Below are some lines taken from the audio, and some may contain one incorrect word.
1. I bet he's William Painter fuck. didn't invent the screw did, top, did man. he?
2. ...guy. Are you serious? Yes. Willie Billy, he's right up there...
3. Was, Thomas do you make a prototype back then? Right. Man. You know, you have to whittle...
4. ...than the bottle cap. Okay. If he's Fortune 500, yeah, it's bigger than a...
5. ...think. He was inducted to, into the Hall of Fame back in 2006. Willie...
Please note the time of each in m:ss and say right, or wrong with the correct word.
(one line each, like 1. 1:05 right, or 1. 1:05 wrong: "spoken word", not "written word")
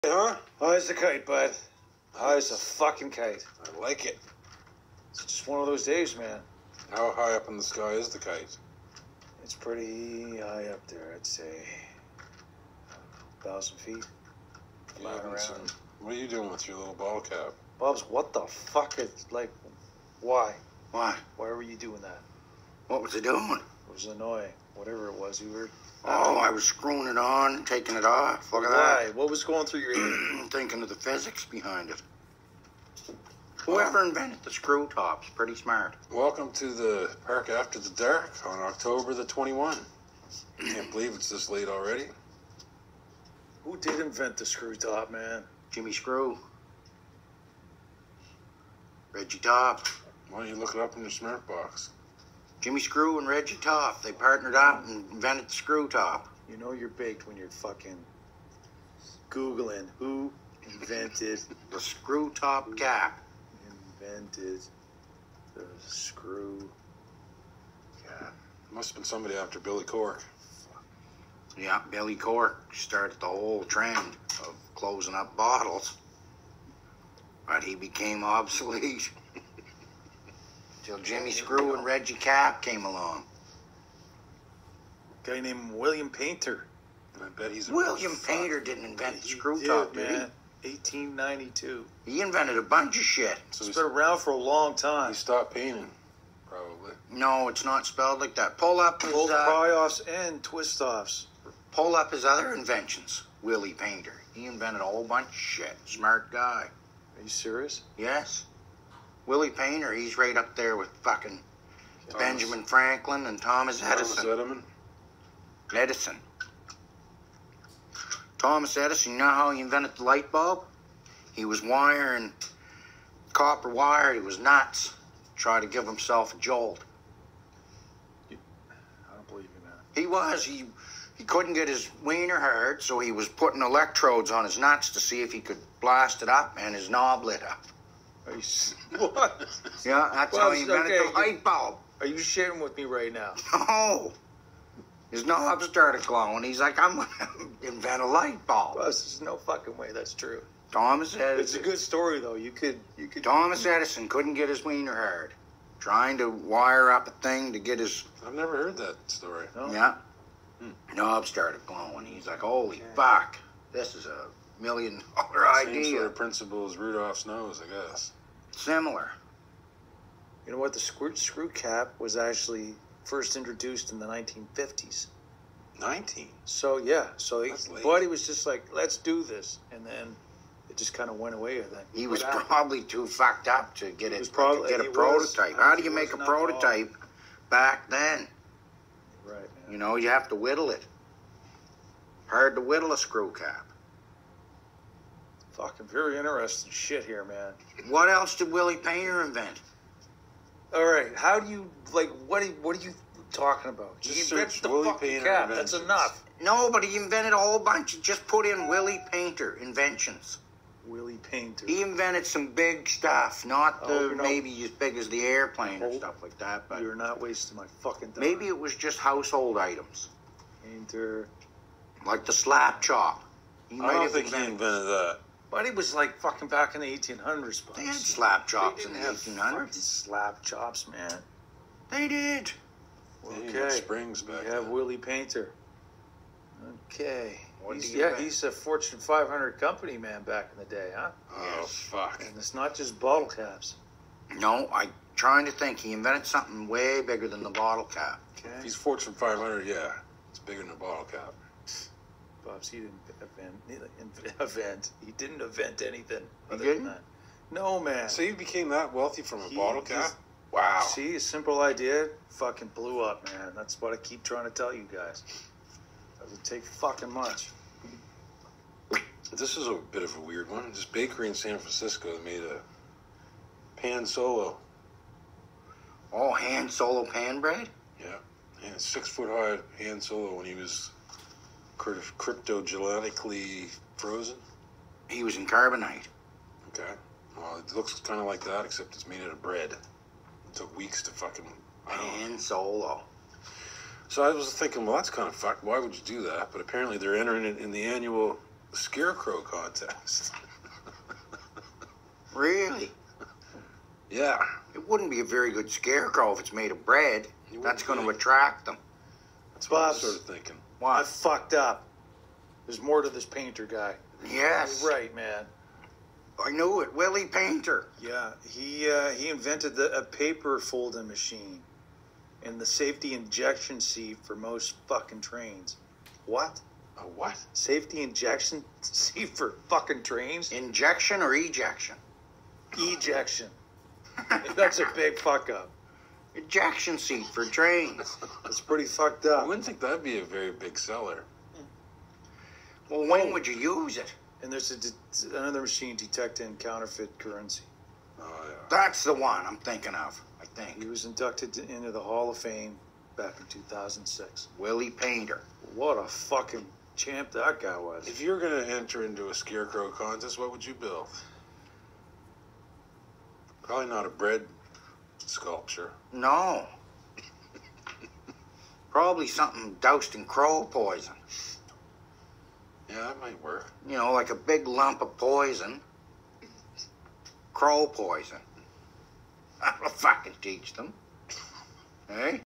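1. 1:27 right
2. 1:46 wrong: "Painter", not "Billy"
3. 3:05 wrong: "How", not "Thomas"
4. 4:07 right
5. 5:50 right.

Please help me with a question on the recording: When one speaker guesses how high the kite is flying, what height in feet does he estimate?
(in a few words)
1,000 feet.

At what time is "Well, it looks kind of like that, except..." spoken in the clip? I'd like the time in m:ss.
4:47.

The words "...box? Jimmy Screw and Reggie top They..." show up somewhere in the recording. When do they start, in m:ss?
0:51.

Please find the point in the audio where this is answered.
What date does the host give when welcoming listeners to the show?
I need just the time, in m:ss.
0:38.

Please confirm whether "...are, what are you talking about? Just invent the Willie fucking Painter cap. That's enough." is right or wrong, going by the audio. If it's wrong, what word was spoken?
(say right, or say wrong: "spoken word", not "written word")
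right.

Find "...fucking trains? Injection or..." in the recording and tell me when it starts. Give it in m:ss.
5:29.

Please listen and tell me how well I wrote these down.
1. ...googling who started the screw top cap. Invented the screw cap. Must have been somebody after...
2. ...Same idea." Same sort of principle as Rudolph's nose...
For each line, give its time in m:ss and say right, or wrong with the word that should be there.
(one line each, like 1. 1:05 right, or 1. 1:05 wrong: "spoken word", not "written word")
1. 0:59 wrong: "invented", not "started"
2. 2:45 right.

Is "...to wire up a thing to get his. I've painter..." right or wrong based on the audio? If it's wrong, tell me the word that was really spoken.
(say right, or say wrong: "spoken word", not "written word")
wrong: "never", not "painter".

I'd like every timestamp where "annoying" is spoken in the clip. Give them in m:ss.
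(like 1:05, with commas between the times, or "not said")
0:24.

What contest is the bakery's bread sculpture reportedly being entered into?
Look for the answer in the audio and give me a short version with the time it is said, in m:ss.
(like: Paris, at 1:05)
annual scarecrow contest, at 4:57.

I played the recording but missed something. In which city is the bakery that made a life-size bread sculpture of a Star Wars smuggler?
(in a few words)
San Francisco.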